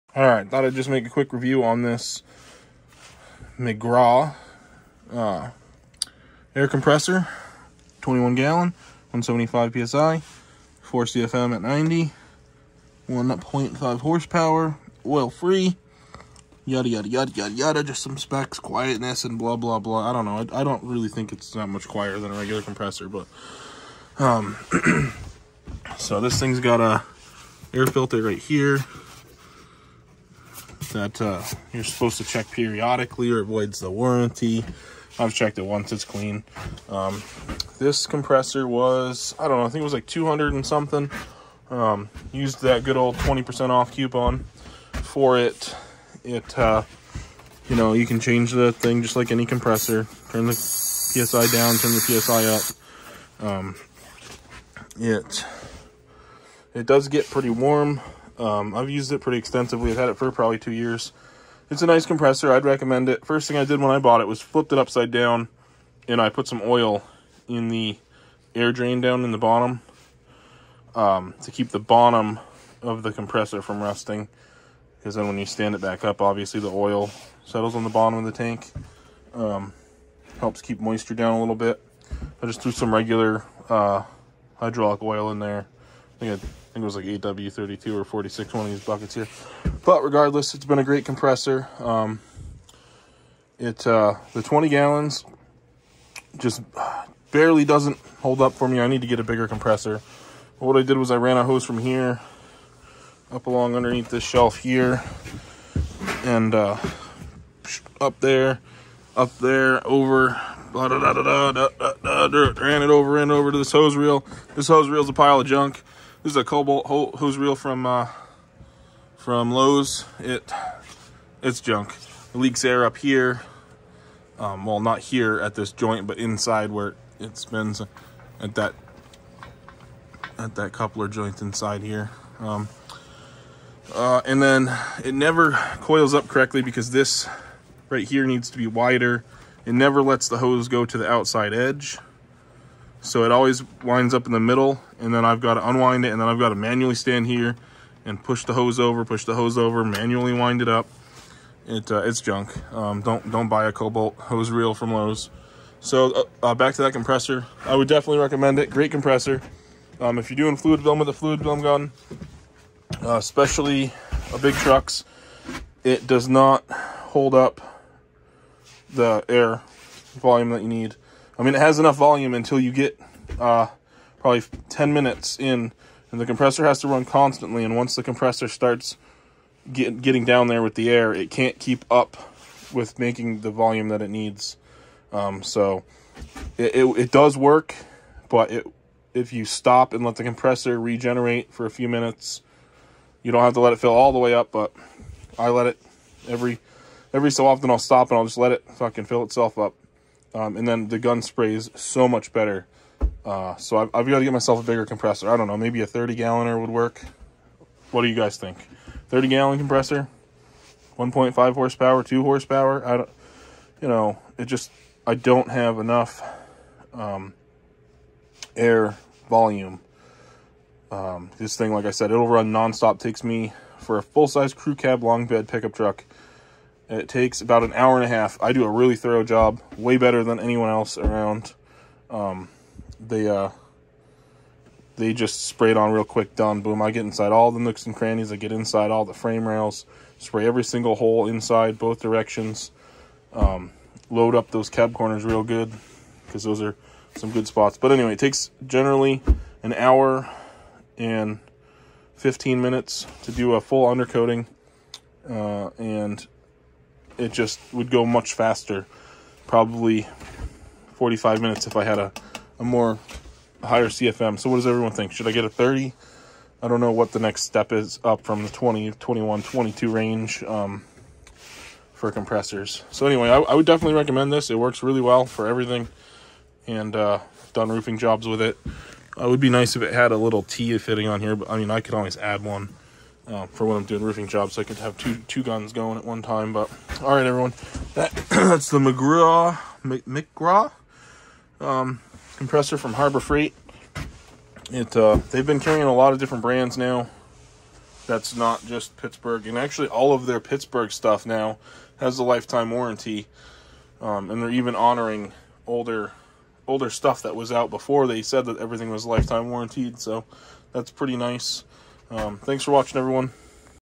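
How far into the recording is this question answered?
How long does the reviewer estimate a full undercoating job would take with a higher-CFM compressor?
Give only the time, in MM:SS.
04:20.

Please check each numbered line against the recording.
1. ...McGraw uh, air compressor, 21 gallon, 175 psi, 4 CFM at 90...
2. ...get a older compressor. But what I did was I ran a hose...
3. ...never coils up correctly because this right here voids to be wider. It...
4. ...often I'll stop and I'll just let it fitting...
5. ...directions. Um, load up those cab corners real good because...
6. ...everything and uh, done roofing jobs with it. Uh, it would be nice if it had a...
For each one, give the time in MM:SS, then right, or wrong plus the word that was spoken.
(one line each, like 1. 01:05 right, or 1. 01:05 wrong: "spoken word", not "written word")
1. 00:03 right
2. 01:39 wrong: "bigger", not "older"
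3. 02:15 wrong: "needs", not "voids"
4. 03:17 wrong: "fucking", not "fitting"
5. 04:02 right
6. 04:35 right.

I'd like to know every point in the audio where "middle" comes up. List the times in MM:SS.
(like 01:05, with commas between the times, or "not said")
02:24.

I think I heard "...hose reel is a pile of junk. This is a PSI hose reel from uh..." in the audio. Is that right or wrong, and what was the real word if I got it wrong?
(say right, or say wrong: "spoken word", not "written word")
wrong: "Kobalt", not "PSI".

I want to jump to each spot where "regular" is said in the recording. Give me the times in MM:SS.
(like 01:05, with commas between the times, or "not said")
00:22, 01:22.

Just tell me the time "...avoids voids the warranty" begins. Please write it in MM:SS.
00:33.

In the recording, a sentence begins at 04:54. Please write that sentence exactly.
It uh, they've been carrying a lot of different brands now.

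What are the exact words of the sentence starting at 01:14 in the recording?
Because then when you stand it back up, obviously the oil settles on the bottom of the tank.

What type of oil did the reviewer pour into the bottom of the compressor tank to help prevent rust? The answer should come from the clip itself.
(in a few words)
hydraulic oil.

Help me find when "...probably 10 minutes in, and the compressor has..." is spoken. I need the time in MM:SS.
02:54.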